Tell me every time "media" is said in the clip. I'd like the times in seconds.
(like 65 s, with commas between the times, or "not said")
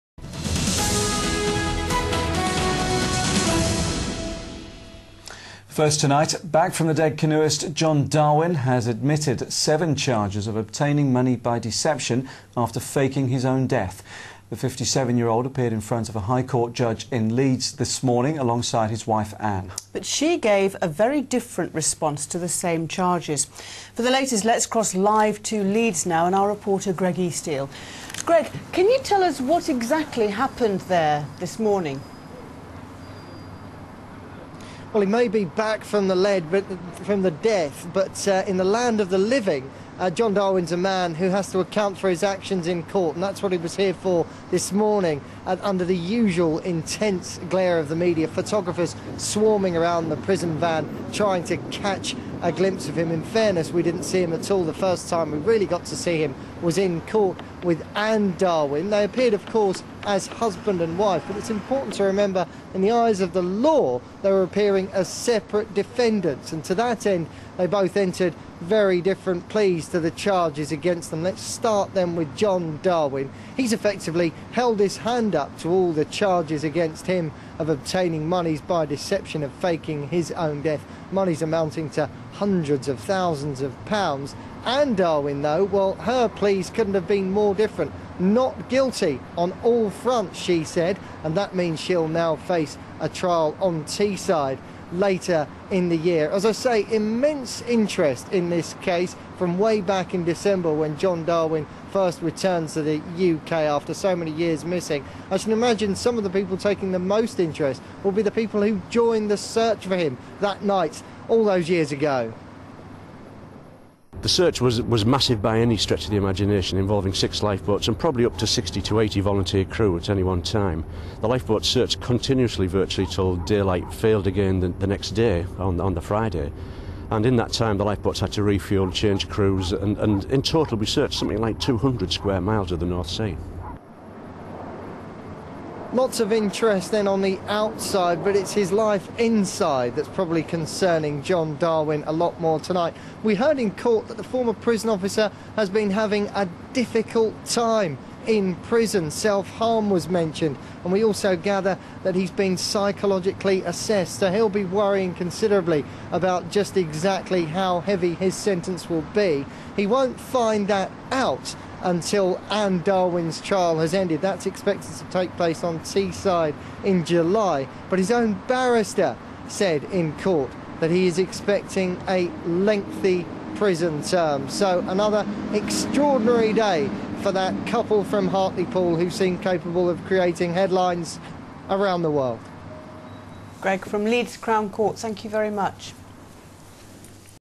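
47 s.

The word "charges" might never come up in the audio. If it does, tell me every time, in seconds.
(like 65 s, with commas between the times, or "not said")
9 s, 22 s, 70 s, 76 s.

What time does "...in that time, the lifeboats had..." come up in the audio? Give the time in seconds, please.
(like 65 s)
127 s.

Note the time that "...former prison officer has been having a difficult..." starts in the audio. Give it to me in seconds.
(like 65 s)
144 s.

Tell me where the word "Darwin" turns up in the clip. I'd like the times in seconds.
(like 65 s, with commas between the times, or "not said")
8 s, 40 s, 58 s, 72 s, 84 s, 101 s, 141 s, 162 s.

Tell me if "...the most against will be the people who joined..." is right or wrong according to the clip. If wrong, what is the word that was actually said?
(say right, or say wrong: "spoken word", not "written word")
wrong: "interest", not "against".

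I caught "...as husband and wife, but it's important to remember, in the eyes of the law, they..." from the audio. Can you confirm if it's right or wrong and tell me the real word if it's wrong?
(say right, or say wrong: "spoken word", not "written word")
right.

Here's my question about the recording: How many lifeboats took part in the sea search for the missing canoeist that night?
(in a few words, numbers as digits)
6.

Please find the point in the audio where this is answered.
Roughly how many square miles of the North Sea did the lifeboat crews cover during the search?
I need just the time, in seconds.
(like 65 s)
131 s.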